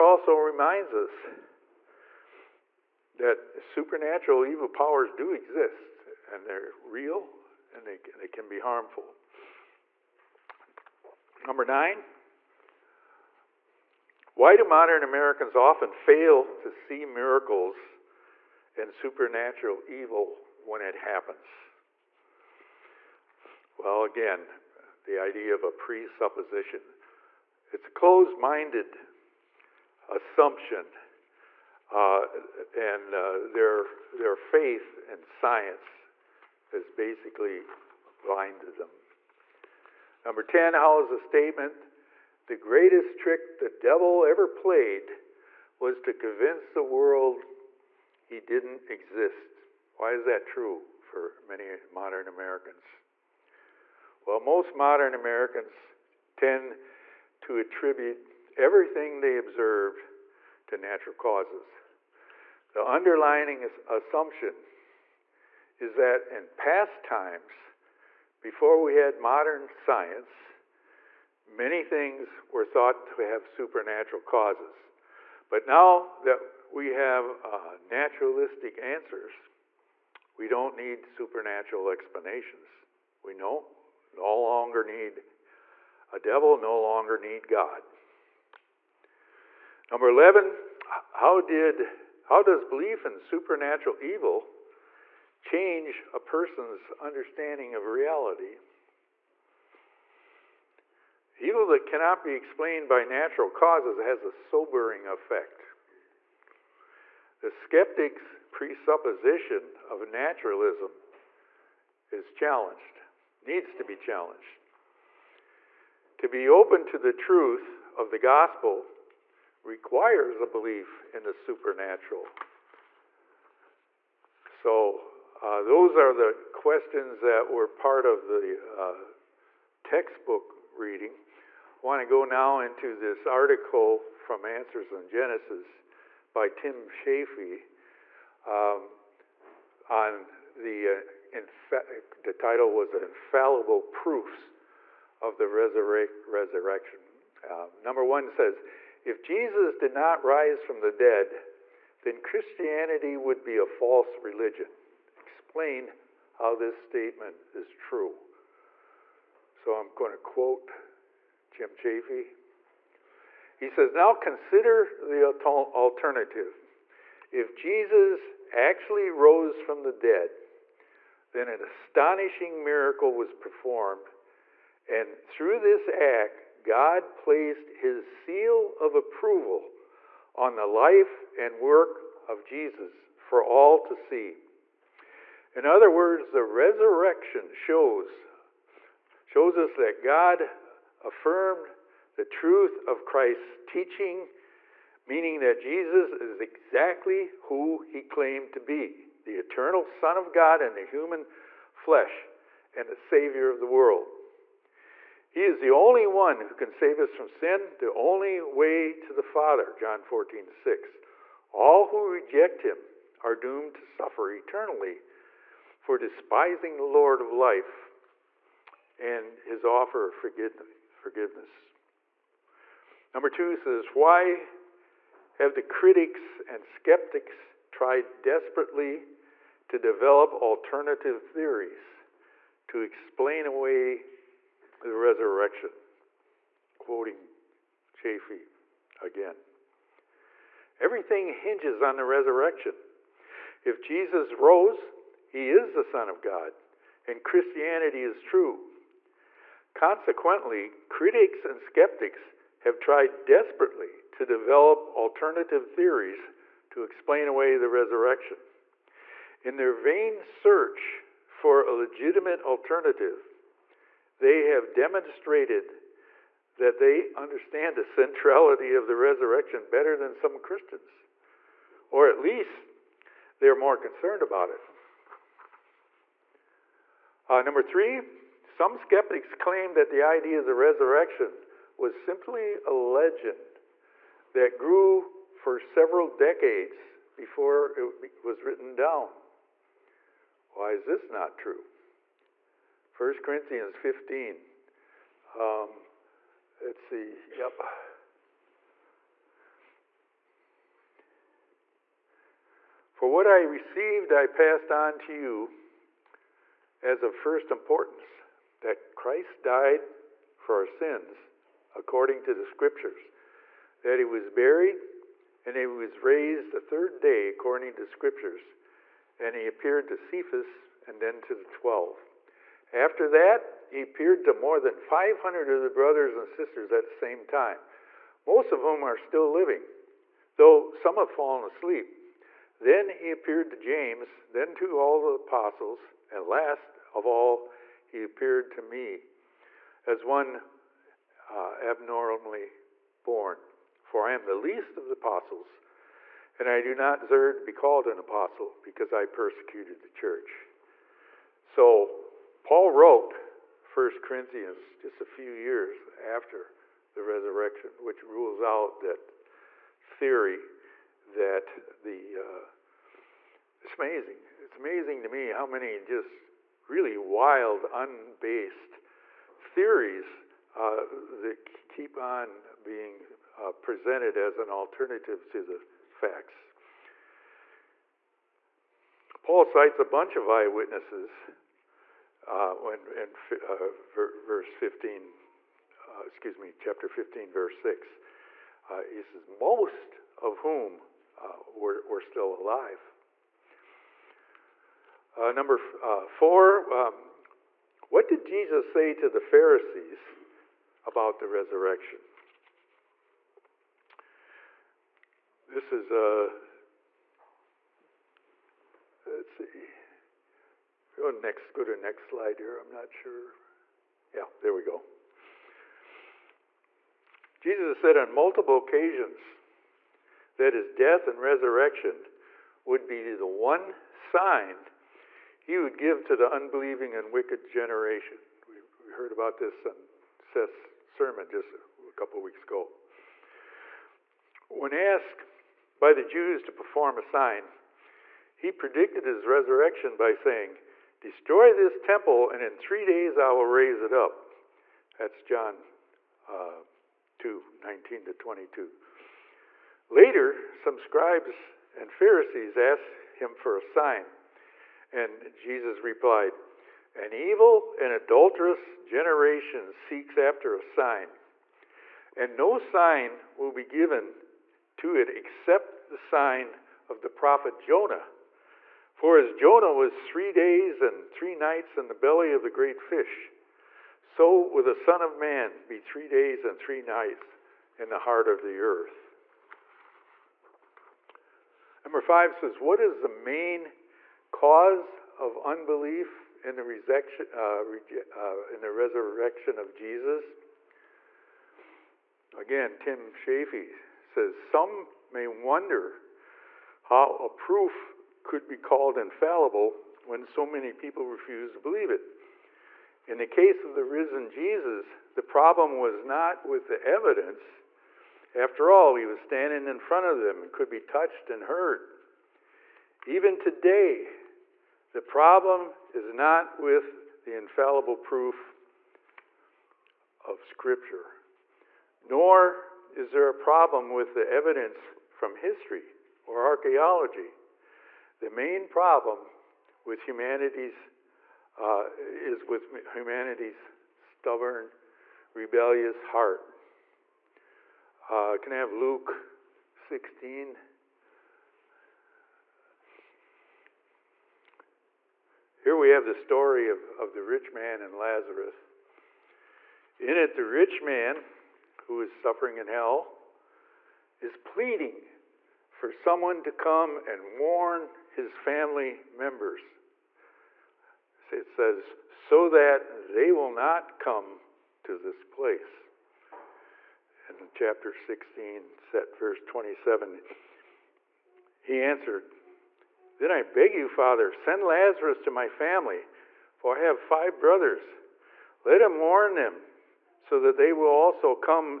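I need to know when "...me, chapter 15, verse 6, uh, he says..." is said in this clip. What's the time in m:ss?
6:26.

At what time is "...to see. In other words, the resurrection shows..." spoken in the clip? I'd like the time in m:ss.
3:03.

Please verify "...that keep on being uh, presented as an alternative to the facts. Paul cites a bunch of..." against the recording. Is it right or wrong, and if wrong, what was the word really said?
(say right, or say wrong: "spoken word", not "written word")
right.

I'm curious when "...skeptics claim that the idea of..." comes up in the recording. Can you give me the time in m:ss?
4:38.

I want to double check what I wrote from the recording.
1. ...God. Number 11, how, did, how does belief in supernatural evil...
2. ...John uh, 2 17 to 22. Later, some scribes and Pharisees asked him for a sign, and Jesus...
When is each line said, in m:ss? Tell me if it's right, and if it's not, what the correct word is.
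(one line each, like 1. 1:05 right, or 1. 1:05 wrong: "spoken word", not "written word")
1. 1:27 right
2. 7:25 wrong: "19", not "17".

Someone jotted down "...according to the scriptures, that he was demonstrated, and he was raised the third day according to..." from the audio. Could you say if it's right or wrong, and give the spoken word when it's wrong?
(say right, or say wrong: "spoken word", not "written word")
wrong: "buried", not "demonstrated".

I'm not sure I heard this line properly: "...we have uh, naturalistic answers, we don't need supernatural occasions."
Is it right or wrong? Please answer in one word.
wrong.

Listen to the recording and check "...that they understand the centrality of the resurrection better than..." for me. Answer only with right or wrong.
right.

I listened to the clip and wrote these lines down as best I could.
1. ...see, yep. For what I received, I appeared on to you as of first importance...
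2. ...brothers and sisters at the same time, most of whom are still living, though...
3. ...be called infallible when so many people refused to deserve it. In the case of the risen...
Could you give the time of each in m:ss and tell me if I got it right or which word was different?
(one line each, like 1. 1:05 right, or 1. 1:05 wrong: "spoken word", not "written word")
1. 4:56 wrong: "passed", not "appeared"
2. 5:25 right
3. 8:18 wrong: "believe", not "deserve".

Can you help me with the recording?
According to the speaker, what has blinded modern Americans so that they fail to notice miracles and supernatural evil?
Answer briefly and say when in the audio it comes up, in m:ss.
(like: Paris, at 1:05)
Faith in science, at 0:34.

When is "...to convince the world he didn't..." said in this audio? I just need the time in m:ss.
0:46.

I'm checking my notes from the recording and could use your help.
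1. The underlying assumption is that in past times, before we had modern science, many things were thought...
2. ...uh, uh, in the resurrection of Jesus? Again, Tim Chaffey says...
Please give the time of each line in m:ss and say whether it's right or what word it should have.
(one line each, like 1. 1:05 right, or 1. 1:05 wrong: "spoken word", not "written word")
1. 1:02 right
2. 8:07 right.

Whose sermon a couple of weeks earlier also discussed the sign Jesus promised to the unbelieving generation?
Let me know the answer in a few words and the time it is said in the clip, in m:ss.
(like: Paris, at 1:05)
Seth, at 7:10.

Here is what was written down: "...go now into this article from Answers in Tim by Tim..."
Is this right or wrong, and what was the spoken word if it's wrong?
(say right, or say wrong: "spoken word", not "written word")
wrong: "Genesis", not "Tim".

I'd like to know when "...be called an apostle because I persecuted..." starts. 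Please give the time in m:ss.
5:47.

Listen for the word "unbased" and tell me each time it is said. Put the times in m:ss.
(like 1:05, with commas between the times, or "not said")
6:07.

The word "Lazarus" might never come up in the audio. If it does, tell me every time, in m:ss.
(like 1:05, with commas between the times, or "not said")
9:07, 9:34.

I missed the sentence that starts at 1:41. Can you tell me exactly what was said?
Evil that cannot be explained by natural causes has a sobering effect.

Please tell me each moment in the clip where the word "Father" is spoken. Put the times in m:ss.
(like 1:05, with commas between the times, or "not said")
3:29, 9:33.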